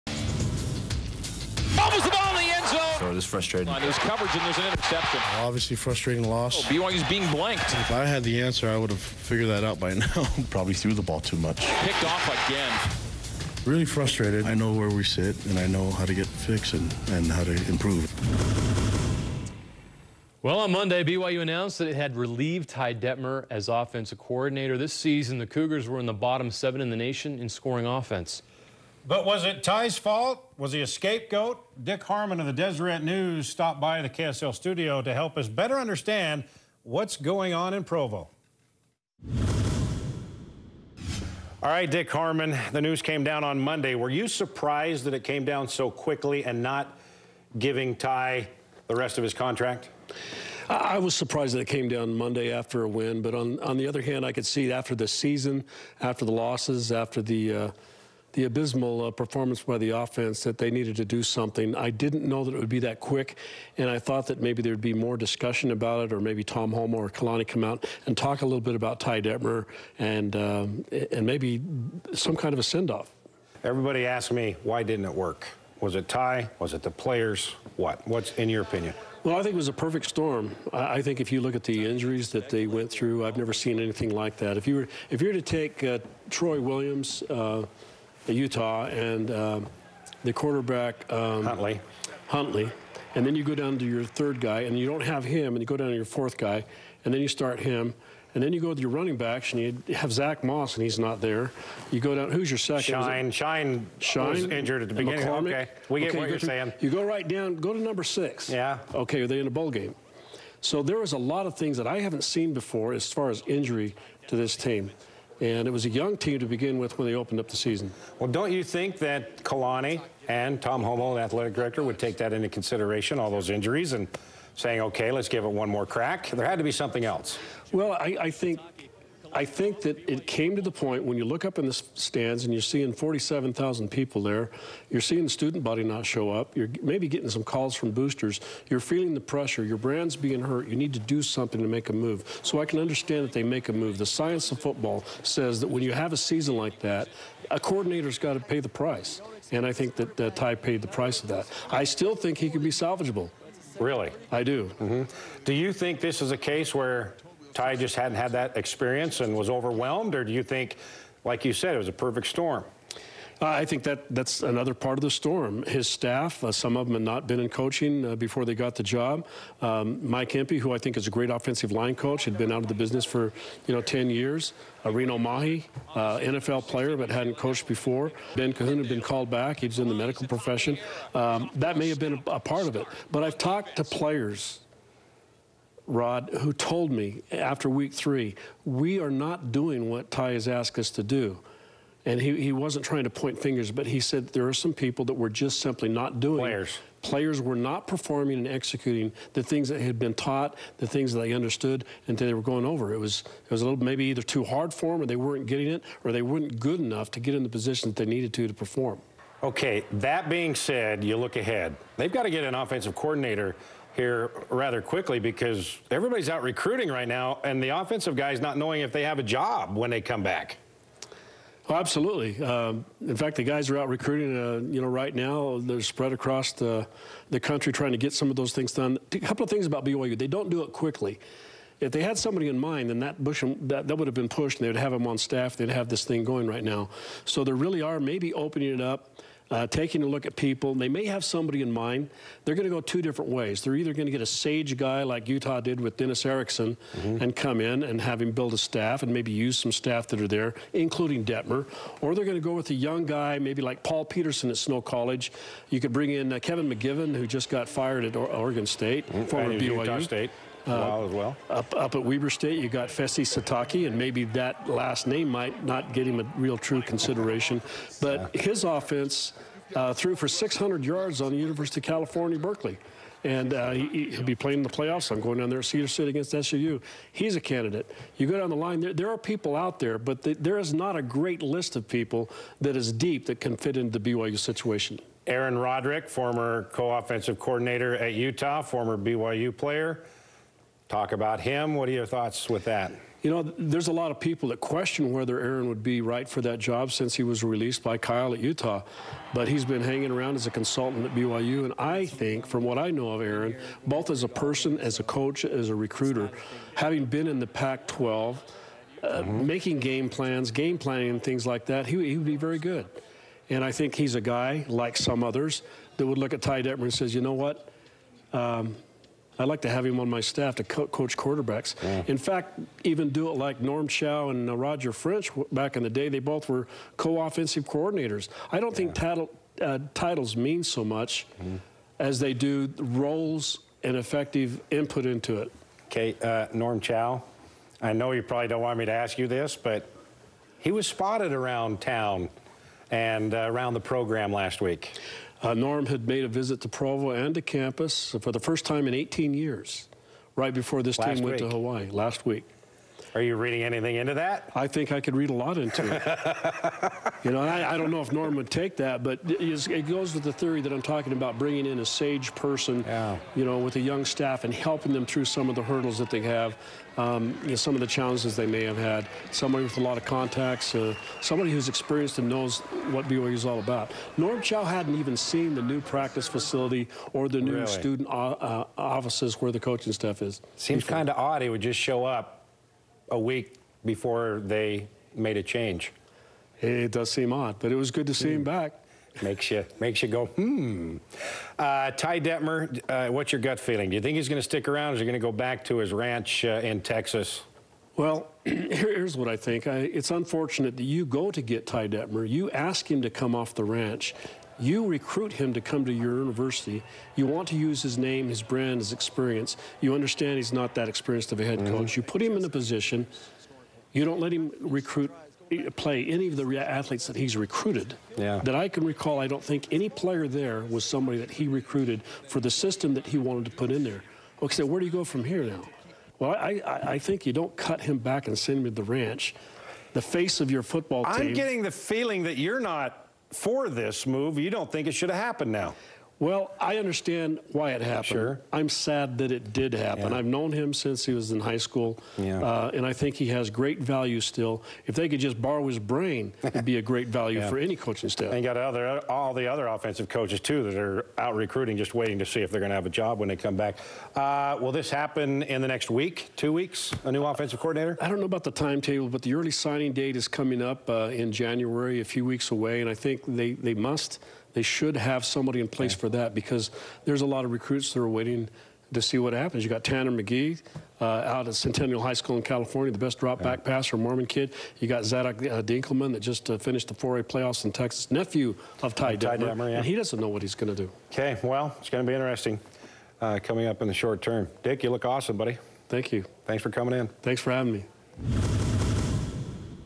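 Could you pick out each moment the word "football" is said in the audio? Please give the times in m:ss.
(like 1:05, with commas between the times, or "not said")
2:24, 7:10.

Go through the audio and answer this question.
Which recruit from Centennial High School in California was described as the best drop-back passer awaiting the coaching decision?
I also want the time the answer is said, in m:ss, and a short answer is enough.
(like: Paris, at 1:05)
Tanner McKee, at 7:49.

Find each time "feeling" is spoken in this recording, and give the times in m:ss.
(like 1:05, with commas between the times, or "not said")
2:18, 6:33, 7:11.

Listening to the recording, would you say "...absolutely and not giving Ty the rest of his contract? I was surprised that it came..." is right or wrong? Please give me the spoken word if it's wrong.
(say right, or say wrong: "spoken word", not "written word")
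wrong: "quickly", not "absolutely".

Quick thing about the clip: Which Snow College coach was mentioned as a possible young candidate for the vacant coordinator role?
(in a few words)
Paul Peterson.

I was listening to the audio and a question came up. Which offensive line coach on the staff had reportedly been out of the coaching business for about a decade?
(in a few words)
Mike Empey.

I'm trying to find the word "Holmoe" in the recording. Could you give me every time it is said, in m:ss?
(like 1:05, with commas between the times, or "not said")
1:06, 2:00.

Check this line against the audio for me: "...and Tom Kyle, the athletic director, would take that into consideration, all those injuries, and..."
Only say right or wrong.
wrong.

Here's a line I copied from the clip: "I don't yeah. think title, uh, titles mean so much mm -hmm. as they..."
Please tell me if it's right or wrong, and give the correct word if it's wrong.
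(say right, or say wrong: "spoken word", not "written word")
right.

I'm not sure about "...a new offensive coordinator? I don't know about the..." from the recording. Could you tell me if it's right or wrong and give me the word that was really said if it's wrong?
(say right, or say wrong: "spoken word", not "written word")
right.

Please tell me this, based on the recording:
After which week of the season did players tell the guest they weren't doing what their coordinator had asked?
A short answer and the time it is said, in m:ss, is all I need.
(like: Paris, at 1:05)
Week three, at 3:07.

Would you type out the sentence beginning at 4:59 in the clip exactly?
But he's been hanging around as a consultant at BYU.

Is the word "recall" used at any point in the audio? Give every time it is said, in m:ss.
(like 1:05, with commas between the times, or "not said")
6:58.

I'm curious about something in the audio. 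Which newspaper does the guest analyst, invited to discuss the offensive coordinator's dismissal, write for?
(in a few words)
Deseret News.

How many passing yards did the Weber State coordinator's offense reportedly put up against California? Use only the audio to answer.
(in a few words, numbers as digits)
600.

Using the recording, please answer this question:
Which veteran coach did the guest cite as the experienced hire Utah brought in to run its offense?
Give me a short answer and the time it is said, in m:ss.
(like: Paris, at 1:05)
Dennis Erickson, at 4:05.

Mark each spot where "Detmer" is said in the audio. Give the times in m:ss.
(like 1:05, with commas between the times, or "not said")
0:22, 1:09, 4:11, 5:16, 6:32, 6:41, 7:59.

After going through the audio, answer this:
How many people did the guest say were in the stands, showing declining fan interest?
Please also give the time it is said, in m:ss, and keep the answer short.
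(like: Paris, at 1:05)
47,000, at 2:12.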